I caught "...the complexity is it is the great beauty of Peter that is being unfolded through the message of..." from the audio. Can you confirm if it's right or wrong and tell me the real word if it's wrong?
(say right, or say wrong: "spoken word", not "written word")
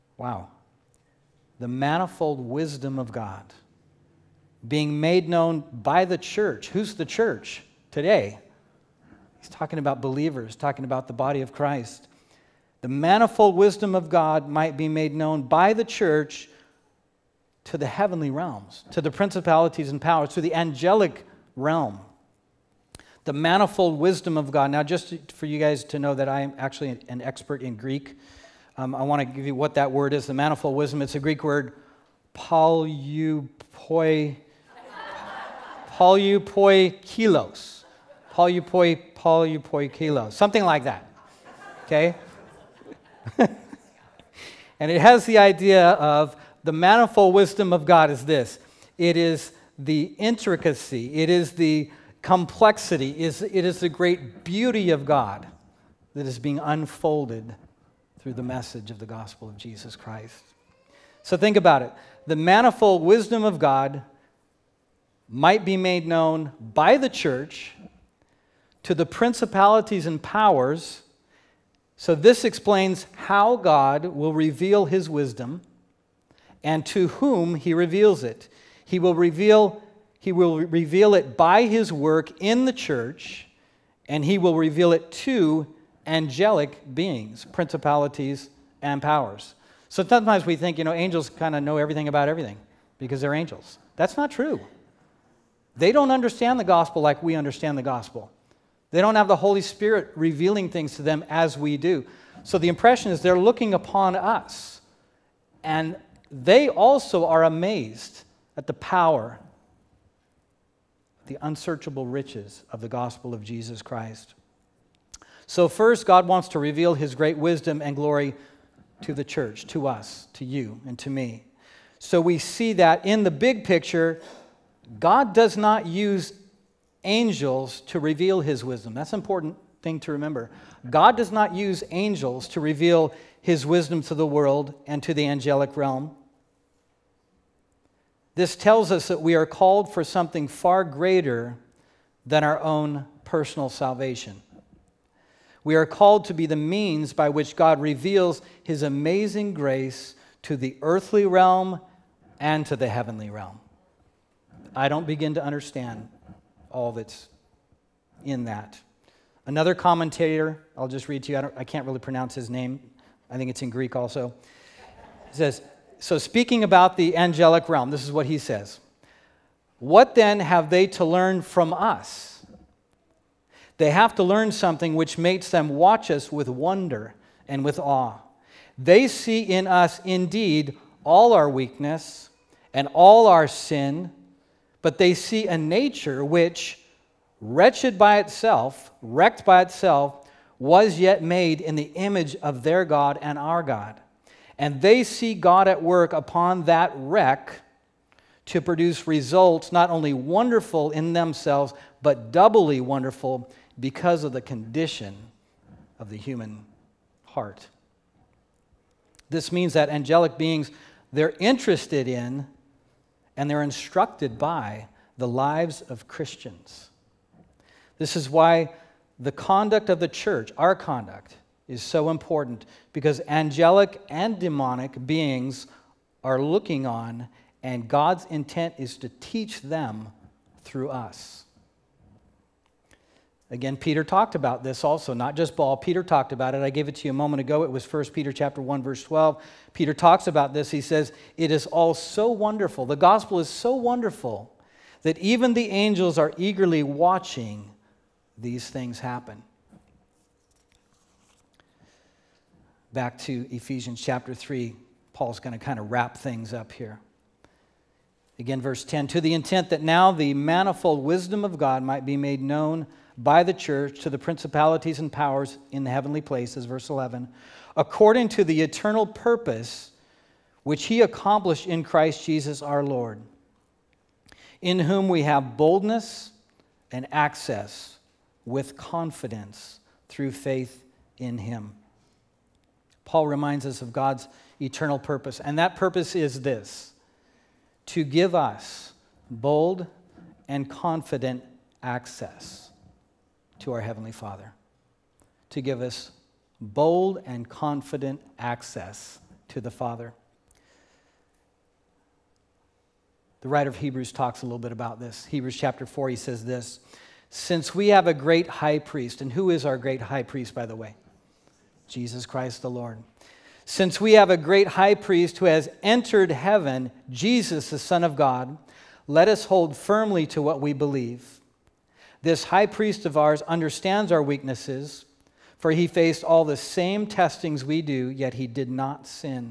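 wrong: "God", not "Peter".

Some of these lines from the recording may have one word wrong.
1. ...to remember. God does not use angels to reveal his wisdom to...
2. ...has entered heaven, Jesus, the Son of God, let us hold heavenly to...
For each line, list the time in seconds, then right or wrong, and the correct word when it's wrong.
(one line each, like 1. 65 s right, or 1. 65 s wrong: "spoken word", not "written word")
1. 129 s right
2. 315 s wrong: "firmly", not "heavenly".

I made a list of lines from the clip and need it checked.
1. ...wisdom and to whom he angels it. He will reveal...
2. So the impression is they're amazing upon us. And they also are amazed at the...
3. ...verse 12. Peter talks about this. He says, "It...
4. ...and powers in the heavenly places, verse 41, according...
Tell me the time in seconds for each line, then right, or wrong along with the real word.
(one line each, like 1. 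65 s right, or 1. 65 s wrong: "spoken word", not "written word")
1. 75 s wrong: "reveals", not "angels"
2. 102 s wrong: "looking", not "amazing"
3. 238 s right
4. 264 s wrong: "11", not "41".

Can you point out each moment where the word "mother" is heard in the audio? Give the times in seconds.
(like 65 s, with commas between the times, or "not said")
not said.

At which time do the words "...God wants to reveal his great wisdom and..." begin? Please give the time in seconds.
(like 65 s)
116 s.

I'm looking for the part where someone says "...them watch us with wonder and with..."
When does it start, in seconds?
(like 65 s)
175 s.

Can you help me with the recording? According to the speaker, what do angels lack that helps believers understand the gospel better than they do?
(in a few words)
the Holy Spirit.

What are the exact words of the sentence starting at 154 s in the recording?
I don't begin to understand all that's in that.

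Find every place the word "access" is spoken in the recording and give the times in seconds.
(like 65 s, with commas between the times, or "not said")
277 s, 291 s, 298 s.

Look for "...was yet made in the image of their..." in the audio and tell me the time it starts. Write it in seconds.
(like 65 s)
190 s.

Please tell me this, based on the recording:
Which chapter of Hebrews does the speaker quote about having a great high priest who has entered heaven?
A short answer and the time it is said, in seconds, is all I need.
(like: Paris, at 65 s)
Chapter 4, at 305 s.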